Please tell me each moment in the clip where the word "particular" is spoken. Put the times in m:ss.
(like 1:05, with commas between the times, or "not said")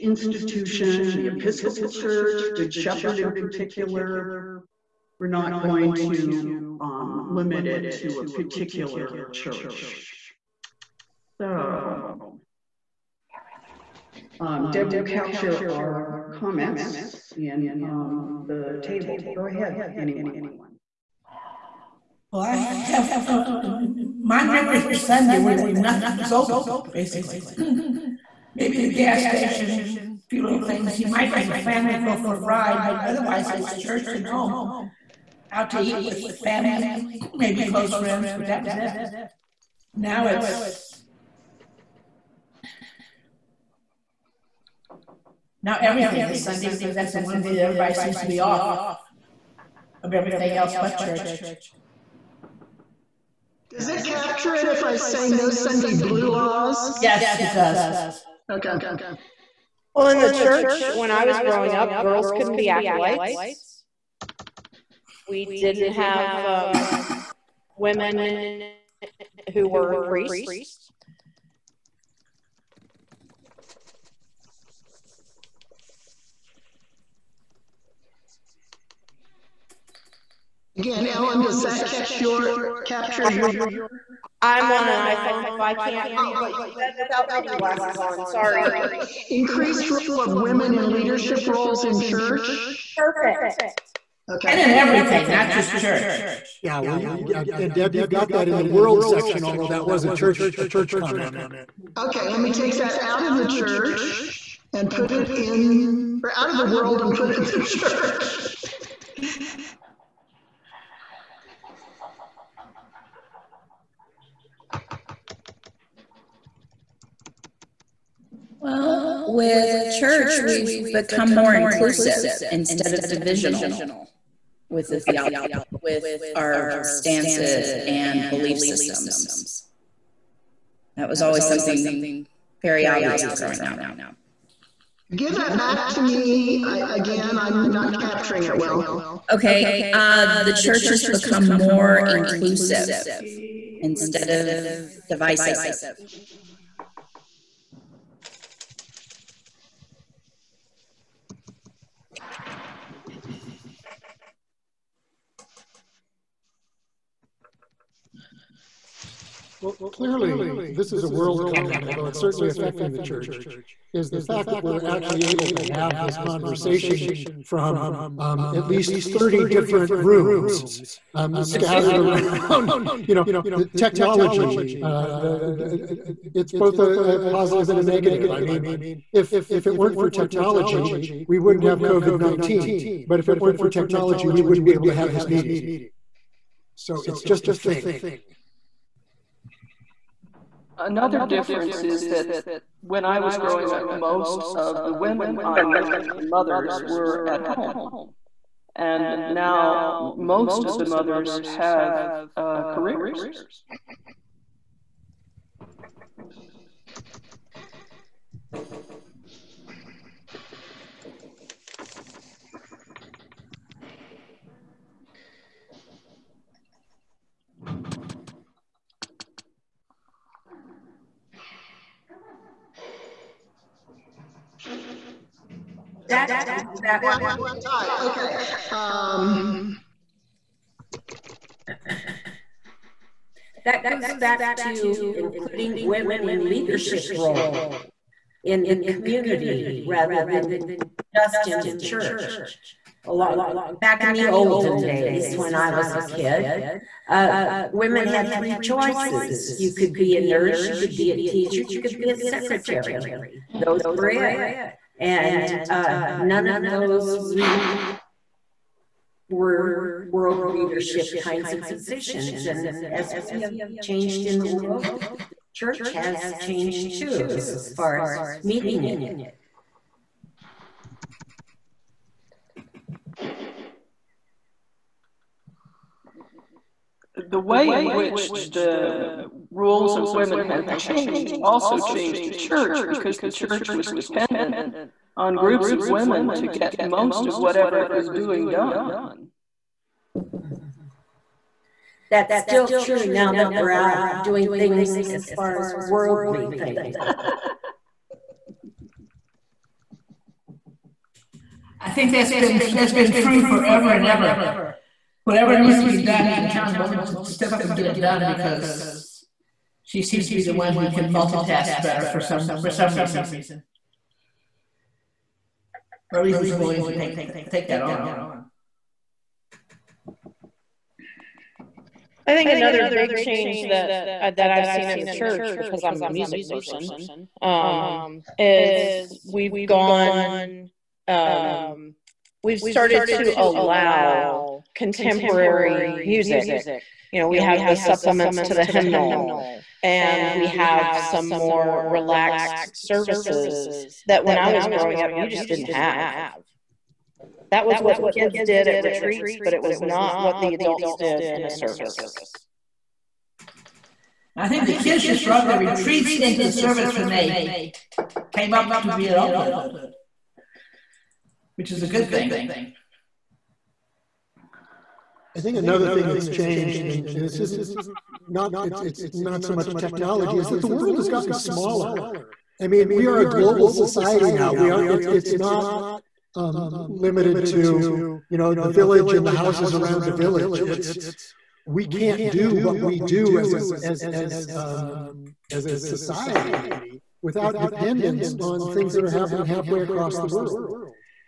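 0:03, 0:08.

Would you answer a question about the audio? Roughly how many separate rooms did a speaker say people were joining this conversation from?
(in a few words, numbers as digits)
30.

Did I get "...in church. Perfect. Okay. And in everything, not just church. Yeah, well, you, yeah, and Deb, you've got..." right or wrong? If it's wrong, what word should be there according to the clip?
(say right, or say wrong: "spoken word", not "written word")
right.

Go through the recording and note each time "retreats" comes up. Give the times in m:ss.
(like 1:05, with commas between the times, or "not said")
5:48, 5:55.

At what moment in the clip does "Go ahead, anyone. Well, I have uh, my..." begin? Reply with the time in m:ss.
0:19.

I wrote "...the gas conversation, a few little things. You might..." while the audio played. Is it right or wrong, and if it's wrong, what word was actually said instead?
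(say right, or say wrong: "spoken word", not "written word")
wrong: "station", not "conversation".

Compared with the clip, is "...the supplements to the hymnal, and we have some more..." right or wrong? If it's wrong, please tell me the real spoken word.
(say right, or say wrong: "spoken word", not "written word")
right.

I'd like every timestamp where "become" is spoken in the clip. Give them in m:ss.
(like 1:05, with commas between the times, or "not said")
2:00, 2:21.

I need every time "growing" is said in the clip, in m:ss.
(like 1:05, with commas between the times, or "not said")
1:01, 2:13, 3:13, 5:44.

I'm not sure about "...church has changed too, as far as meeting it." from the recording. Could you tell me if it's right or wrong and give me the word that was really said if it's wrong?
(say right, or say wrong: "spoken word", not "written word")
right.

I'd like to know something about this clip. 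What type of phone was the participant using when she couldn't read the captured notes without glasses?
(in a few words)
iPhone.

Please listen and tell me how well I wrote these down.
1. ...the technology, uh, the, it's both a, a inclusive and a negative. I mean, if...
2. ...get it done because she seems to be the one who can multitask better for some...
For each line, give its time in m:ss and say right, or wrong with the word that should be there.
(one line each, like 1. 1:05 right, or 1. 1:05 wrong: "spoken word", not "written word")
1. 2:53 wrong: "positive", not "inclusive"
2. 5:07 right.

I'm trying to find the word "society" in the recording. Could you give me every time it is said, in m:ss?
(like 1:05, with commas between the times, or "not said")
6:13, 6:25.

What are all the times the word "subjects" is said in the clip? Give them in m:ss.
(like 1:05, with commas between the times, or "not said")
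not said.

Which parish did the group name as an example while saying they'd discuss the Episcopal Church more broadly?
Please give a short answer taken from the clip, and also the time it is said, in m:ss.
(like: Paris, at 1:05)
Good Shepherd, at 0:02.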